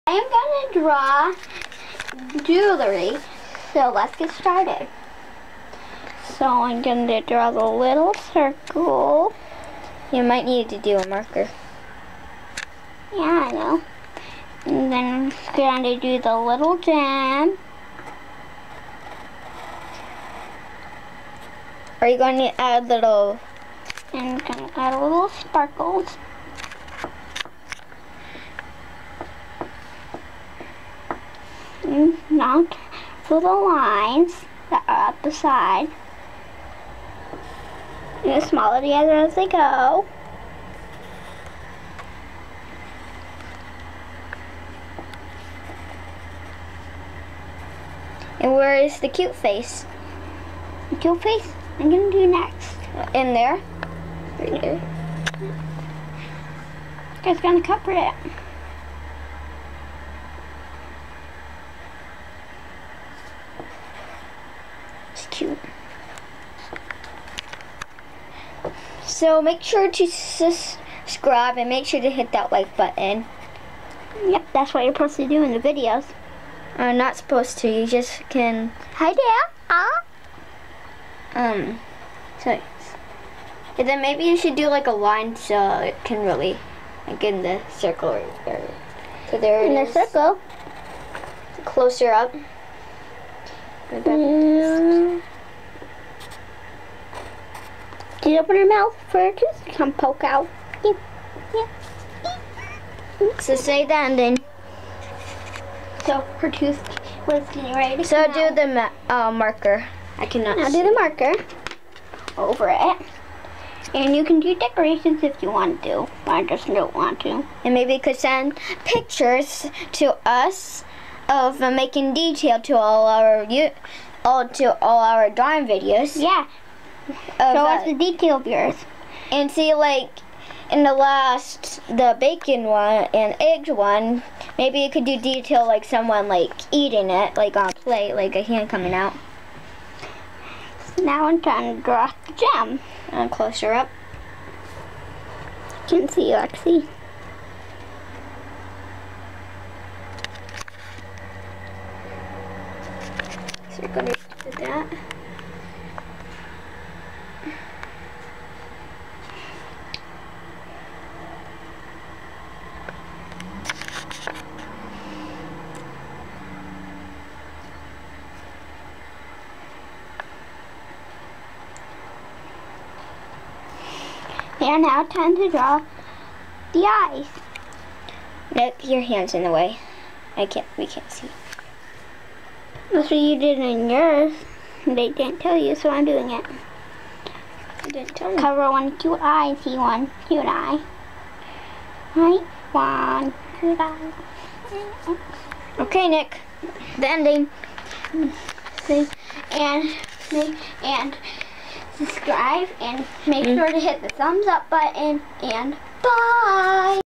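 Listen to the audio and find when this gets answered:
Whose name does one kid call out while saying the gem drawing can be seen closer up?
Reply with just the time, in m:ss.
2:26.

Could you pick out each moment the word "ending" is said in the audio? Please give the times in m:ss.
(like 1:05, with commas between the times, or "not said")
3:17.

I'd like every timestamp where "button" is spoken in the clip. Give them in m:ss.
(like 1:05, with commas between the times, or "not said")
1:12, 3:24.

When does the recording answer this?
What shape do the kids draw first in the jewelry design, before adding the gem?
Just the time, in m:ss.
0:07.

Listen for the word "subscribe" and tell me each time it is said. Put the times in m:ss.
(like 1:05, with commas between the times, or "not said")
1:10, 3:22.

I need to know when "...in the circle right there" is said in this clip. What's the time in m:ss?
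1:27.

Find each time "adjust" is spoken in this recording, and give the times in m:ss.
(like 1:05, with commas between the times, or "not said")
not said.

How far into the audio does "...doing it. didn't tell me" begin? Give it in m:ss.
3:06.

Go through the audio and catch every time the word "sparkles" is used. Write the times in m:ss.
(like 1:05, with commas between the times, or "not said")
0:25.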